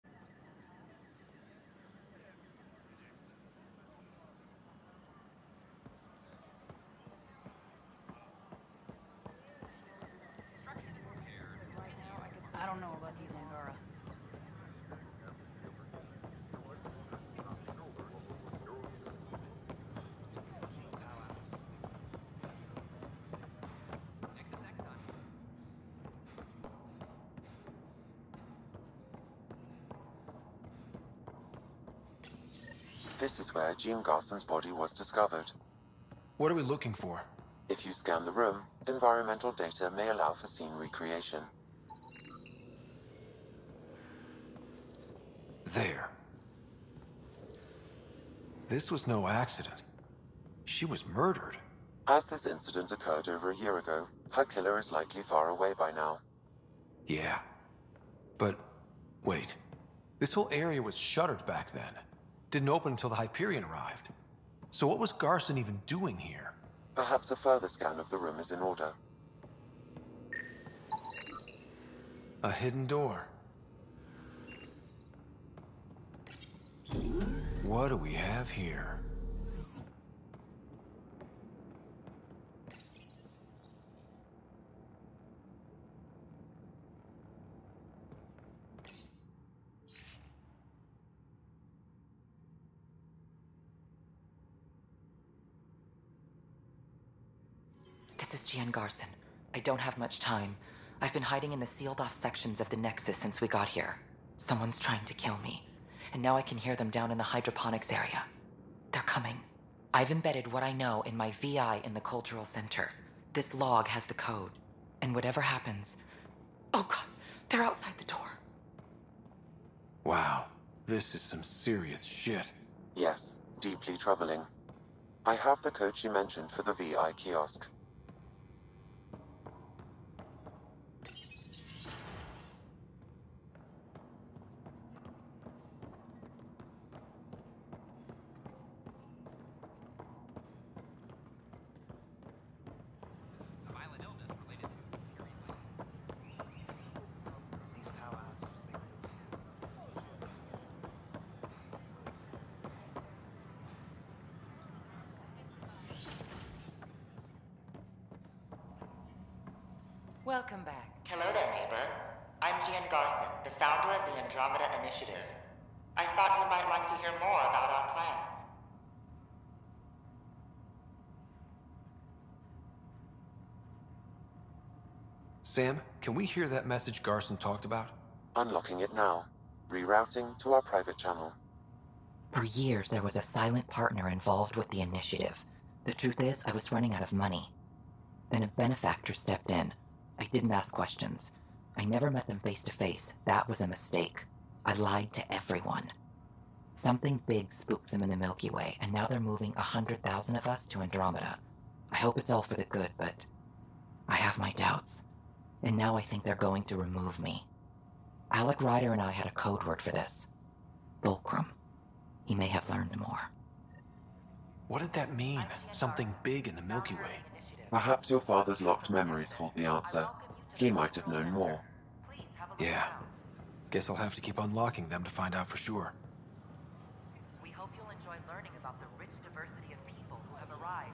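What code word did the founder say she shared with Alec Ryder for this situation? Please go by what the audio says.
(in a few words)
Fulcrum.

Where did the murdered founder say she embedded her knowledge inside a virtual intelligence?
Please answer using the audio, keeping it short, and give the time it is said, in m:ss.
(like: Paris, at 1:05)
The cultural center, at 1:52.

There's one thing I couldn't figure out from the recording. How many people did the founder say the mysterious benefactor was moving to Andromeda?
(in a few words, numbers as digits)
100,000.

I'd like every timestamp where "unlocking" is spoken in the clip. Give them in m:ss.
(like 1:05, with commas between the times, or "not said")
2:58, 3:44.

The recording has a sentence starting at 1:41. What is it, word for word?
I've been hiding in the sealed off sections of the Nexus since we got here.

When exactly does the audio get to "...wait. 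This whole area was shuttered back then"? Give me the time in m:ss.
0:59.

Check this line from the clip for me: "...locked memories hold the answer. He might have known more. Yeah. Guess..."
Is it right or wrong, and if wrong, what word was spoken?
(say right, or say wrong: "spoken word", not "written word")
right.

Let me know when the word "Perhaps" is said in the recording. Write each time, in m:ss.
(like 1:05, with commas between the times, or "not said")
1:06, 3:37.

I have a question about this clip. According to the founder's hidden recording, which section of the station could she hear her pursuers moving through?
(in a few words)
Hydroponics.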